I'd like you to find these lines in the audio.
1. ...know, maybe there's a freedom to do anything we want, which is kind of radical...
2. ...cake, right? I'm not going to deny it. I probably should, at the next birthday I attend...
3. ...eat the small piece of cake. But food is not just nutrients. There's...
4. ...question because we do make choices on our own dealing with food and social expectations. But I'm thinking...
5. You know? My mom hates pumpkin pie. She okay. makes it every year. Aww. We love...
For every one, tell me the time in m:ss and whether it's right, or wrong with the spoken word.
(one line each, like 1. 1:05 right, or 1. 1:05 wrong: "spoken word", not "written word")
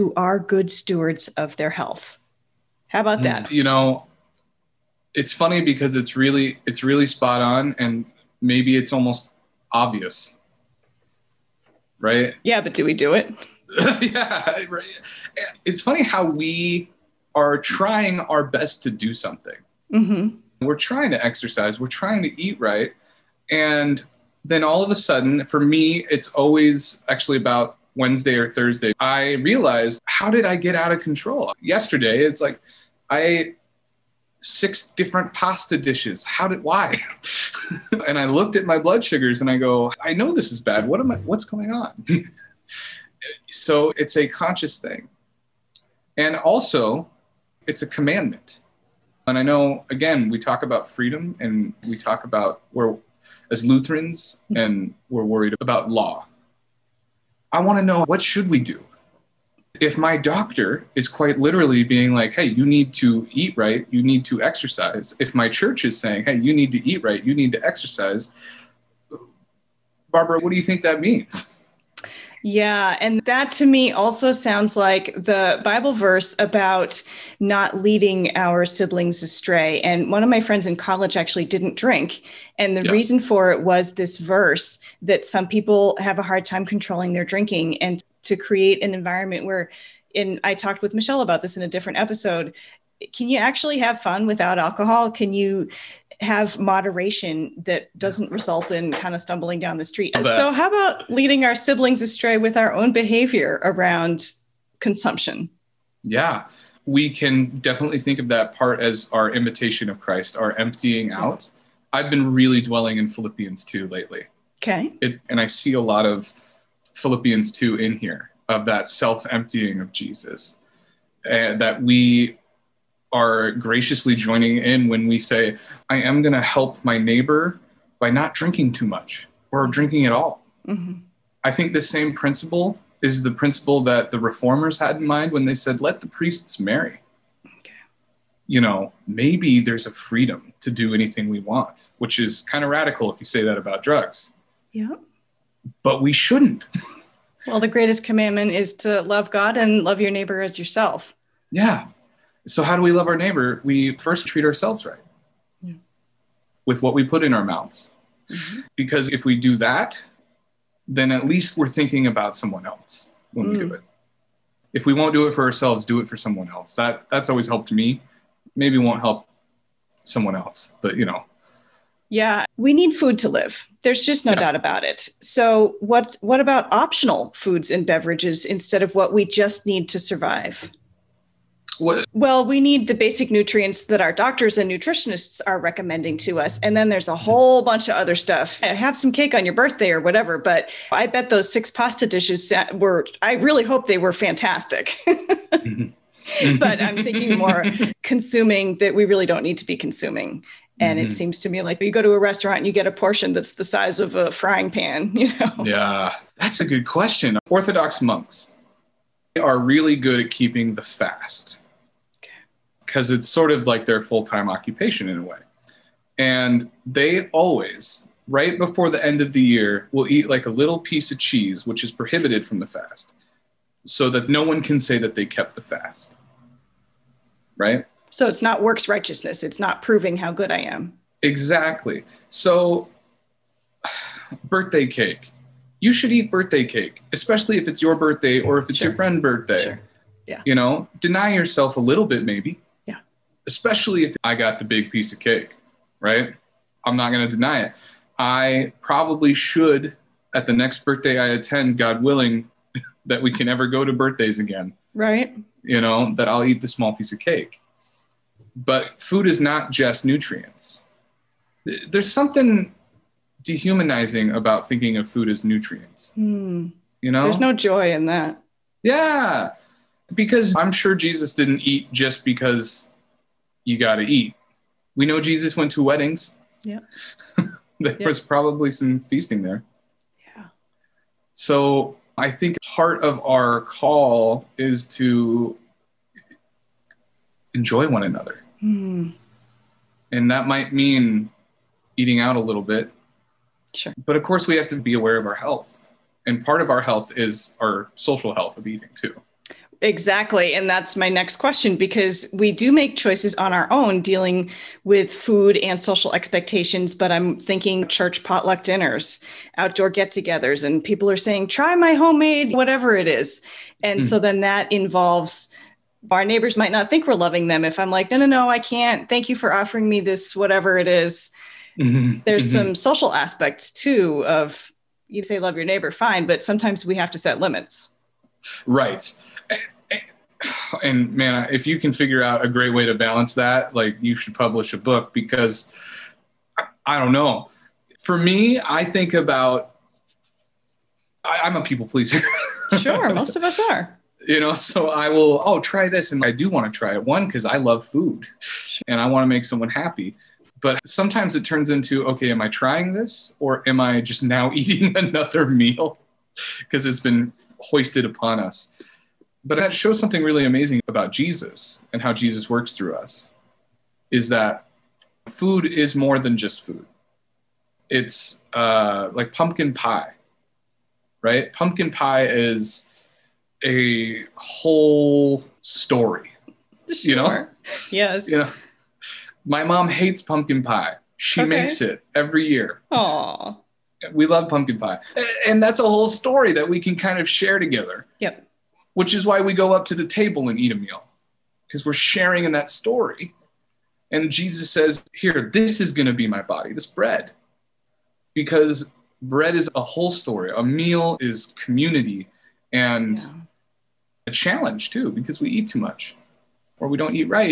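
1. 2:18 right
2. 4:05 right
3. 4:16 right
4. 5:01 right
5. 6:18 right.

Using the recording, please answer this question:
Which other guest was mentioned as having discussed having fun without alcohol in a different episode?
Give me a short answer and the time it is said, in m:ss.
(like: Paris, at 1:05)
Michelle, at 1:30.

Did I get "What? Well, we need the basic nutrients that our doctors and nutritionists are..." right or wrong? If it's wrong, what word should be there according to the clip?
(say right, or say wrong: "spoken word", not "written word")
right.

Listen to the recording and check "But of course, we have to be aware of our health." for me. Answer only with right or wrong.
right.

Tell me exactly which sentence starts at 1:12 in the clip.
Yeah, and that to me also sounds like the Bible verse about not leading our siblings astray.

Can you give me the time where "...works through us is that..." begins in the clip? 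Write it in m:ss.
6:02.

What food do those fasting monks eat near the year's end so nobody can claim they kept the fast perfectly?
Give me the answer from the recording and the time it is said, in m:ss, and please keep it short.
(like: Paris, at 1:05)
cheese, at 3:41.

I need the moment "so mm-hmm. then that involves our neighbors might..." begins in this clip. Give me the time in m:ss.
5:14.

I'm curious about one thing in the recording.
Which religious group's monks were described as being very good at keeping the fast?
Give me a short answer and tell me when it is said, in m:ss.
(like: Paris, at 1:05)
Orthodox, at 3:27.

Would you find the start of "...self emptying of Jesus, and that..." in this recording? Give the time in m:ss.
1:58.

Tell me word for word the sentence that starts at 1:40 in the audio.
So, how about leading our siblings astray with our own behavior around consumption?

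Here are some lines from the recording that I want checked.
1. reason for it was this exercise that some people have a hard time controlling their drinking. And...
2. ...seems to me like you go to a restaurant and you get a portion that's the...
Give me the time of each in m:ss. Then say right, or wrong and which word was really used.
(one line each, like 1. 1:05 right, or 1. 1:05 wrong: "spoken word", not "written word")
1. 1:22 wrong: "verse", not "exercise"
2. 3:21 right.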